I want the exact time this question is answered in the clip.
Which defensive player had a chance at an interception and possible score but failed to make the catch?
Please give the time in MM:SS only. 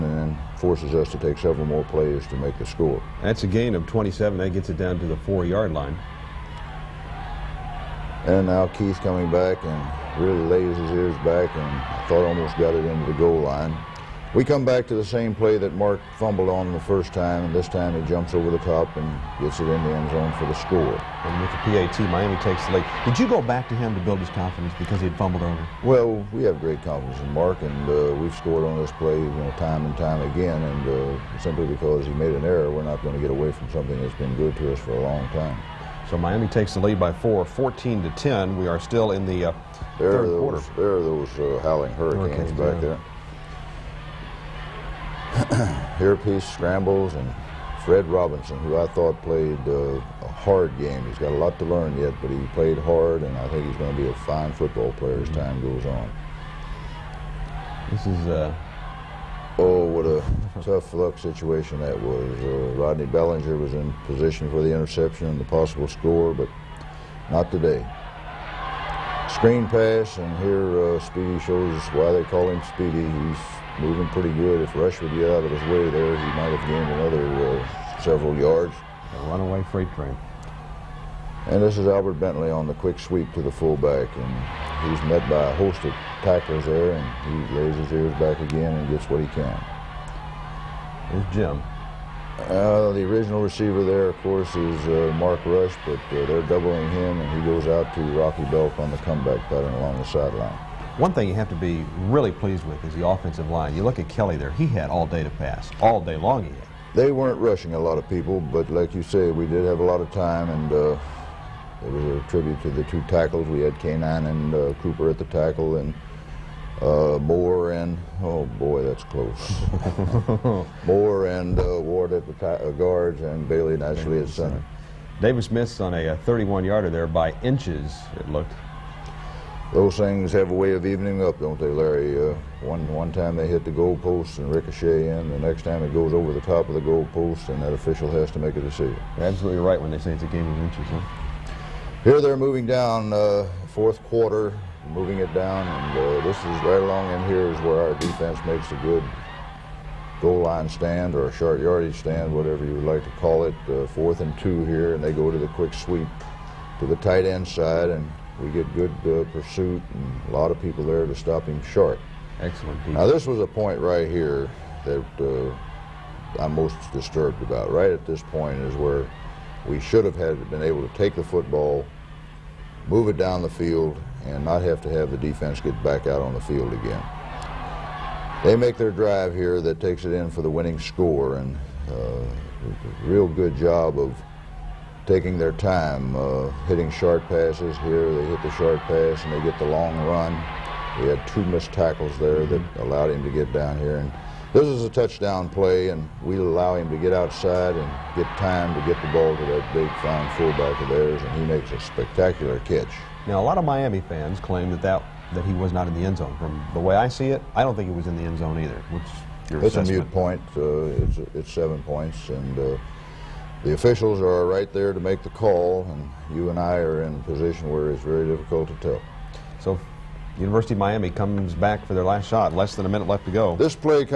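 01:02.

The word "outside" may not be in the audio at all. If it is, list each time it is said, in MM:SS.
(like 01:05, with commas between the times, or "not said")
03:17.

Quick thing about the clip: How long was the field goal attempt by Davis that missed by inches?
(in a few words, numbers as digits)
31 yards.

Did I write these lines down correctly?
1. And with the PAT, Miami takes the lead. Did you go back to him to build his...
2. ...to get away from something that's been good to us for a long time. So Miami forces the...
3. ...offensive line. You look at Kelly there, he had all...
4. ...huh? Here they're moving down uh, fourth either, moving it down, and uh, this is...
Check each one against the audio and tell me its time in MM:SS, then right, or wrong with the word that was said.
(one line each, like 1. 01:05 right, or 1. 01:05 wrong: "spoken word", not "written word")
1. 00:21 right
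2. 00:33 wrong: "takes", not "forces"
3. 01:43 right
4. 02:20 wrong: "quarter", not "either".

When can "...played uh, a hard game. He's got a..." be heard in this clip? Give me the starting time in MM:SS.
00:49.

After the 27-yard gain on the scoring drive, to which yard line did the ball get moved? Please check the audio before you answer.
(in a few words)
4-yard line.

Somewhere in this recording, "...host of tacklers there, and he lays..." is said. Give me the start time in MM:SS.
01:25.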